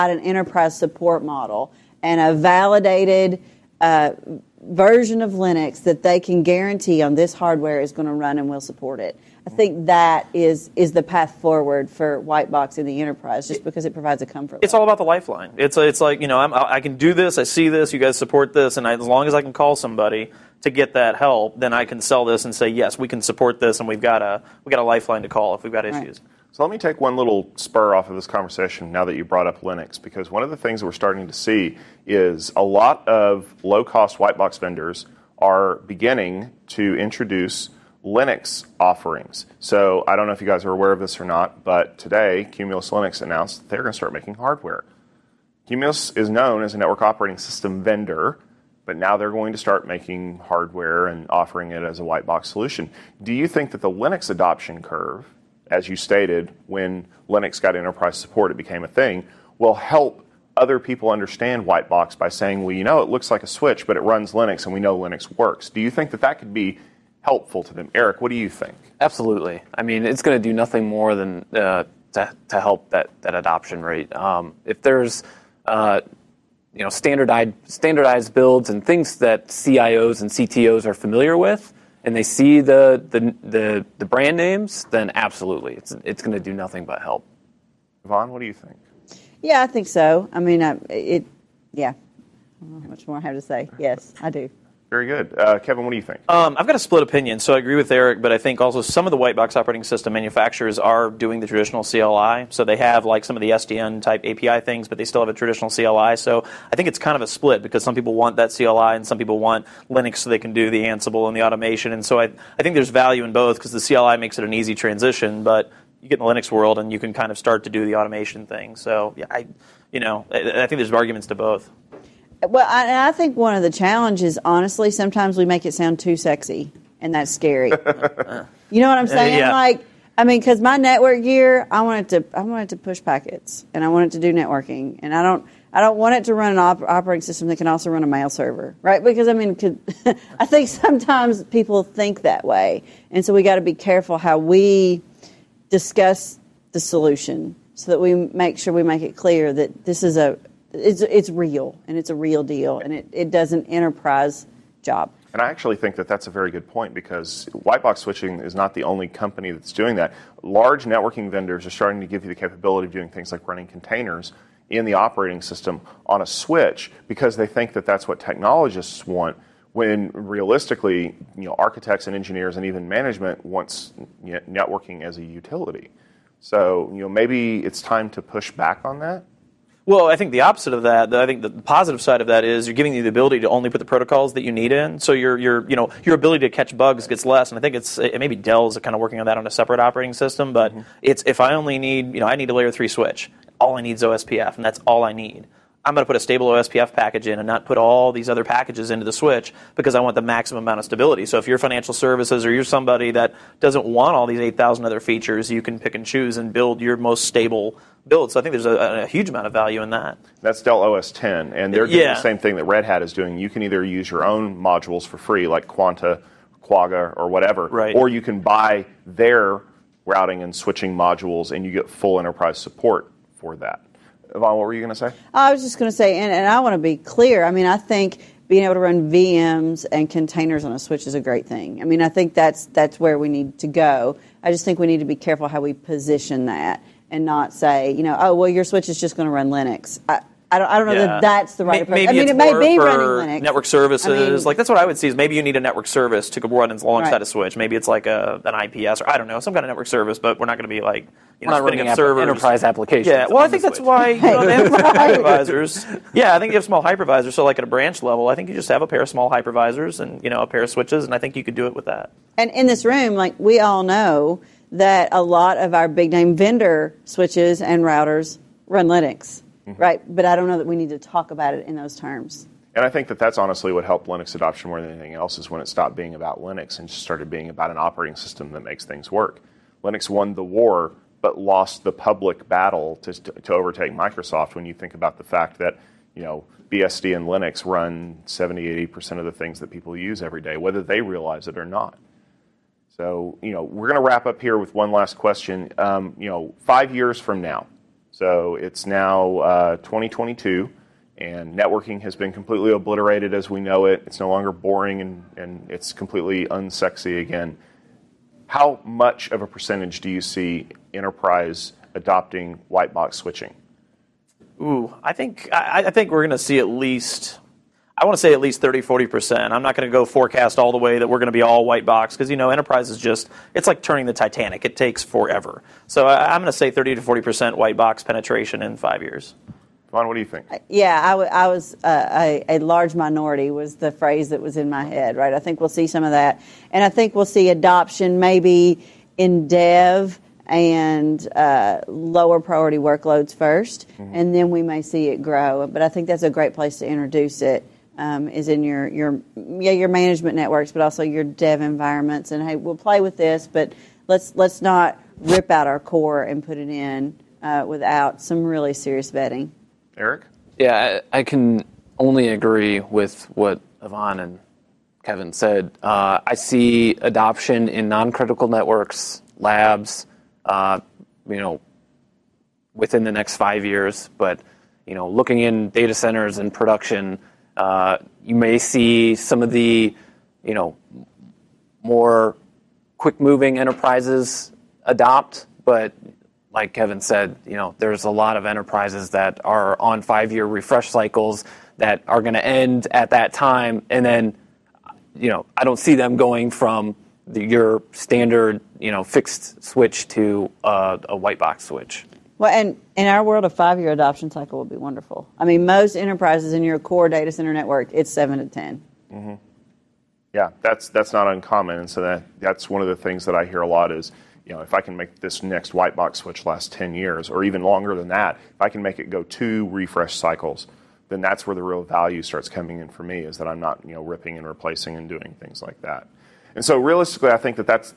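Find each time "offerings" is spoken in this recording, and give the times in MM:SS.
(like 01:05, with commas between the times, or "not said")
00:38, 00:51.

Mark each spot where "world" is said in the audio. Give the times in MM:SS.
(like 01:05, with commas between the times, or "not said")
01:56, 06:43.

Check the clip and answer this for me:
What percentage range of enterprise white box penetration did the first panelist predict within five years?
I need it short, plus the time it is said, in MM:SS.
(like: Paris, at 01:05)
30 to 40%, at 05:26.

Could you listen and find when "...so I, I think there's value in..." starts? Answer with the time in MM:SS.
01:52.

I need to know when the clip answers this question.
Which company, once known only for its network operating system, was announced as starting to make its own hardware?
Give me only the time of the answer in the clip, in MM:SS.
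00:42.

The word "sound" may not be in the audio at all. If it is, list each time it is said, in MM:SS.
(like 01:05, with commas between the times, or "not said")
02:05.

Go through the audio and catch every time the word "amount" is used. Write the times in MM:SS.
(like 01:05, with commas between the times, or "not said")
03:20, 03:29.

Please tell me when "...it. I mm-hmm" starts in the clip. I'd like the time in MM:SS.
00:08.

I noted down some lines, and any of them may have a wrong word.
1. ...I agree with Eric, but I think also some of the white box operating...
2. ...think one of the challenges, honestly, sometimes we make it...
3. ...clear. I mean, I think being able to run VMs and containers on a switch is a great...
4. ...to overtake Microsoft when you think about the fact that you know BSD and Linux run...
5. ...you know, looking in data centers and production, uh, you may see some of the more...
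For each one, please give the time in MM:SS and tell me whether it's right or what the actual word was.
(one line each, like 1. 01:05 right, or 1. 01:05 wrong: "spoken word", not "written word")
1. 01:37 right
2. 02:03 right
3. 03:46 right
4. 04:43 right
5. 06:14 right.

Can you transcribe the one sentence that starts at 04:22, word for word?
And in this room, like, we all know that a lot of our big name vendor switches and routers run Linux.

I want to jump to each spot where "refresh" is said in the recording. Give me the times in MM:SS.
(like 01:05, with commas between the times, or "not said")
06:30, 06:59.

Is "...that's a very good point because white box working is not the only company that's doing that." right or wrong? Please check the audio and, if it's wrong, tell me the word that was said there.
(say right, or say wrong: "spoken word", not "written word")
wrong: "switching", not "working".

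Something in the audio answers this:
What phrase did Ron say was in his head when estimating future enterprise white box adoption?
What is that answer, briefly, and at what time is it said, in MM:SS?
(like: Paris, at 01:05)
large minority, at 05:32.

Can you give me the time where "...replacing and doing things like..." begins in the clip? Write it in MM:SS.
07:04.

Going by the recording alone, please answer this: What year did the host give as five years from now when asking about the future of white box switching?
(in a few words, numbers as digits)
2022.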